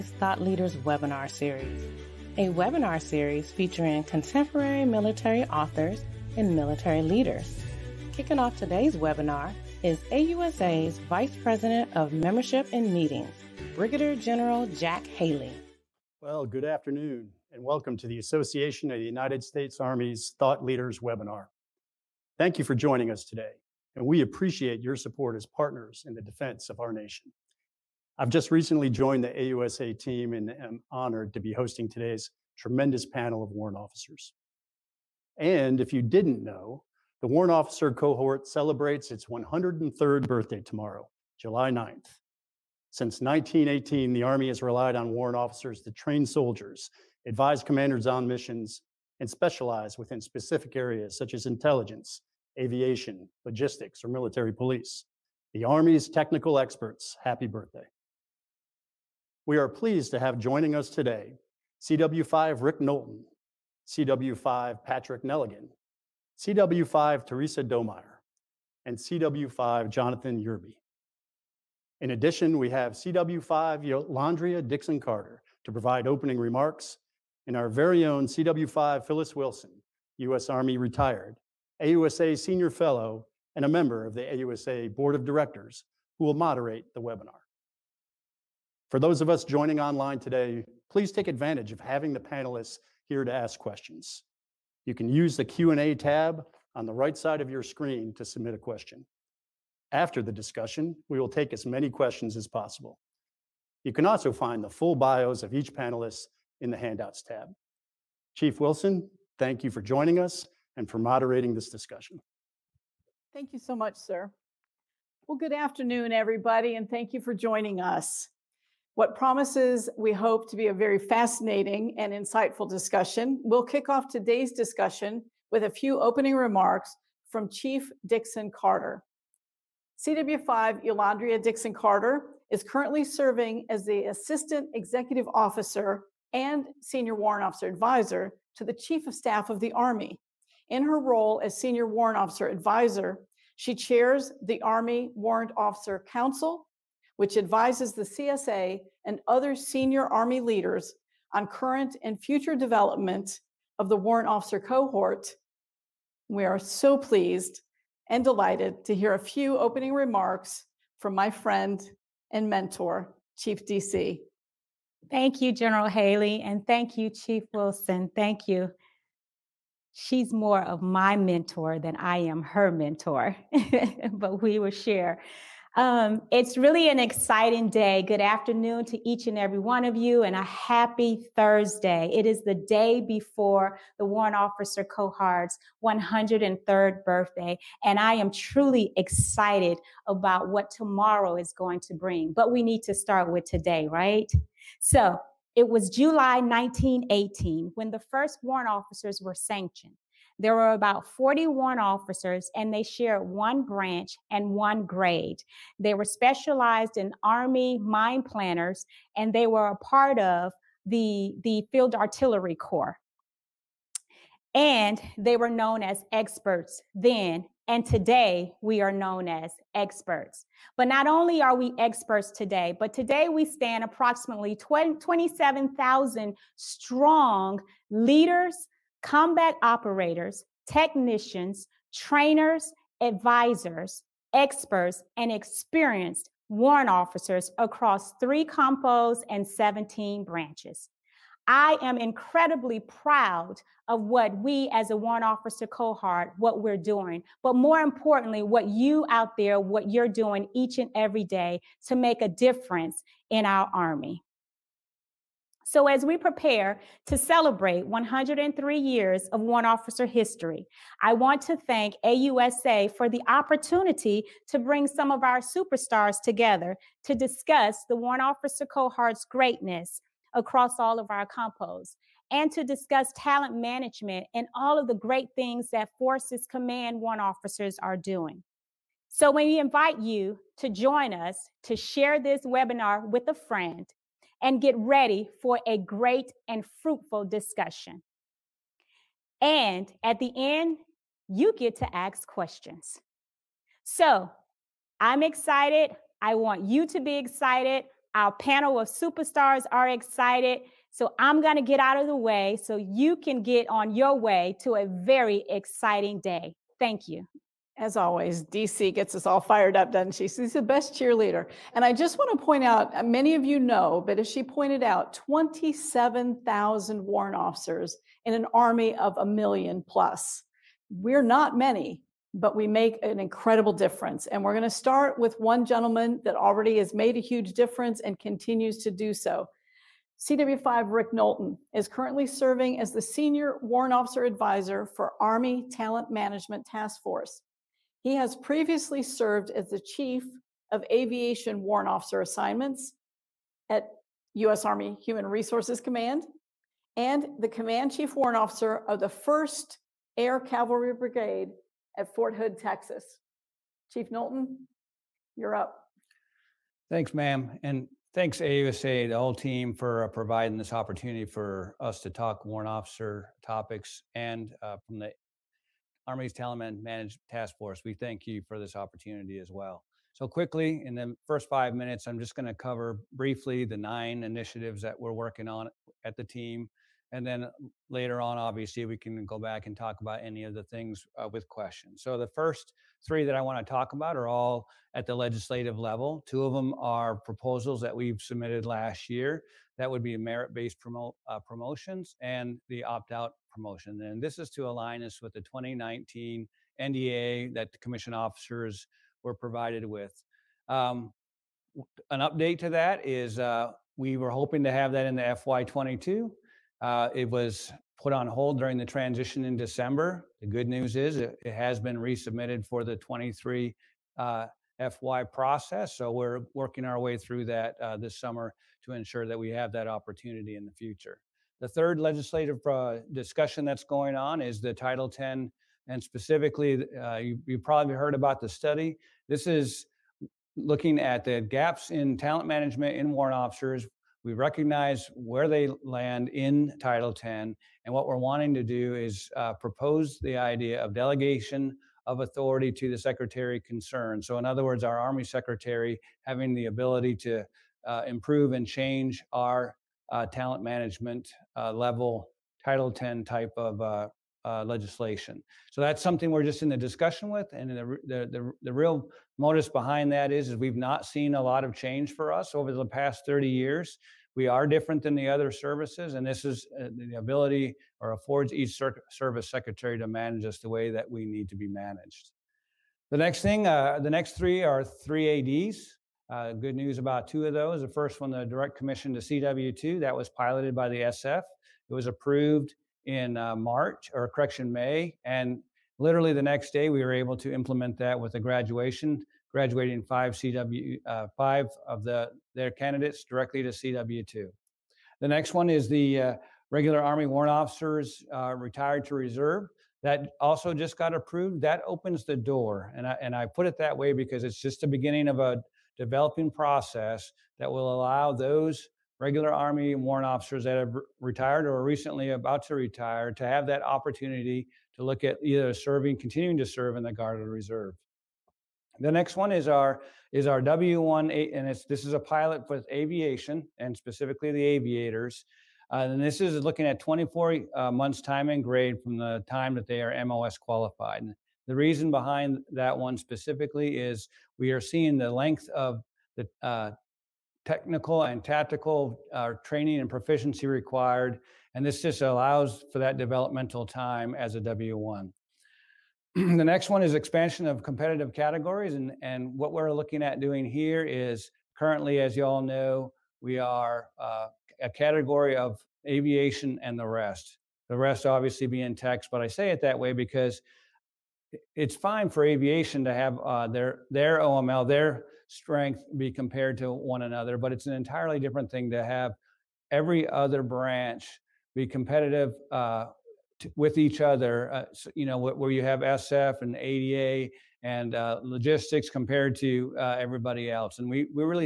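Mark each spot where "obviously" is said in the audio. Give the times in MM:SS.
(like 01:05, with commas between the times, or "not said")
06:18, 09:18.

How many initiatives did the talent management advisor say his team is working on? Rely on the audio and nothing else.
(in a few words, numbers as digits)
9.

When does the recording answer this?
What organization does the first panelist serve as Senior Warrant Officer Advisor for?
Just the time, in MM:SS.
05:35.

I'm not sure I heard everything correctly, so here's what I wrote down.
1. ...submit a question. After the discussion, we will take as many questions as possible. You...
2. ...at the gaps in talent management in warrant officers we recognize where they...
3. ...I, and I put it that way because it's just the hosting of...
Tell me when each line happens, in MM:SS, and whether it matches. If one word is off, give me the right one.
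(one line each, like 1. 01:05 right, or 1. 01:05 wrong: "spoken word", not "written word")
1. 01:38 right
2. 07:10 right
3. 08:23 wrong: "beginning", not "hosting".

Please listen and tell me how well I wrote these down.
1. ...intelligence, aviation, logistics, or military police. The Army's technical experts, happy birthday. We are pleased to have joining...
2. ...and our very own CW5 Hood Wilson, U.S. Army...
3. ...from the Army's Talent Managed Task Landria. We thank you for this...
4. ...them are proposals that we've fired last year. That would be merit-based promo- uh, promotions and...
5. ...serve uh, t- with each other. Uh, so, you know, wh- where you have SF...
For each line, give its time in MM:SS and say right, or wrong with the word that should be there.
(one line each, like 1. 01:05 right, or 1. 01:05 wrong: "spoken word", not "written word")
1. 00:51 right
2. 01:17 wrong: "Phyllis", not "Hood"
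3. 06:04 wrong: "Force", not "Landria"
4. 06:26 wrong: "submitted", not "fired"
5. 09:31 wrong: "competitive", not "serve".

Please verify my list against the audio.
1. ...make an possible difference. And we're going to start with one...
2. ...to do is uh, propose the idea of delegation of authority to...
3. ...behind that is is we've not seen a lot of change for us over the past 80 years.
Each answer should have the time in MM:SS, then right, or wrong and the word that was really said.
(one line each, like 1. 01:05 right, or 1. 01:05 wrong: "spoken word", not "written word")
1. 05:22 wrong: "incredible", not "possible"
2. 07:18 right
3. 07:39 wrong: "30", not "80".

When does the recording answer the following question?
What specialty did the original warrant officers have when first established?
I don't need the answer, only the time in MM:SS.
03:27.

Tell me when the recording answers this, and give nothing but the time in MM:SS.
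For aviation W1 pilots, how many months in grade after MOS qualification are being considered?
08:46.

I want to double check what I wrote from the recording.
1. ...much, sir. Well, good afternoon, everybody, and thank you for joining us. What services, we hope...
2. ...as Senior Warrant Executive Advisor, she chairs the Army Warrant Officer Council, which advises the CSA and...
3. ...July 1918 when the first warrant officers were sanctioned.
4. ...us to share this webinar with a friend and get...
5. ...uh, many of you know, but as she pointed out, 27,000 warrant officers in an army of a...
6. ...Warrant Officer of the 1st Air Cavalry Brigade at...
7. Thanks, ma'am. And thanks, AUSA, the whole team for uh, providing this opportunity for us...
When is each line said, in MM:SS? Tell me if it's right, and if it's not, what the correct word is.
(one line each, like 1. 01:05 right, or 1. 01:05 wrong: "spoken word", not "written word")
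1. 01:53 wrong: "promises", not "services"
2. 02:21 wrong: "Officer", not "Executive"
3. 03:15 right
4. 04:41 right
5. 05:12 right
6. 05:48 right
7. 05:56 right.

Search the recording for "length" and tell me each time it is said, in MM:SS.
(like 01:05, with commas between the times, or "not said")
08:55.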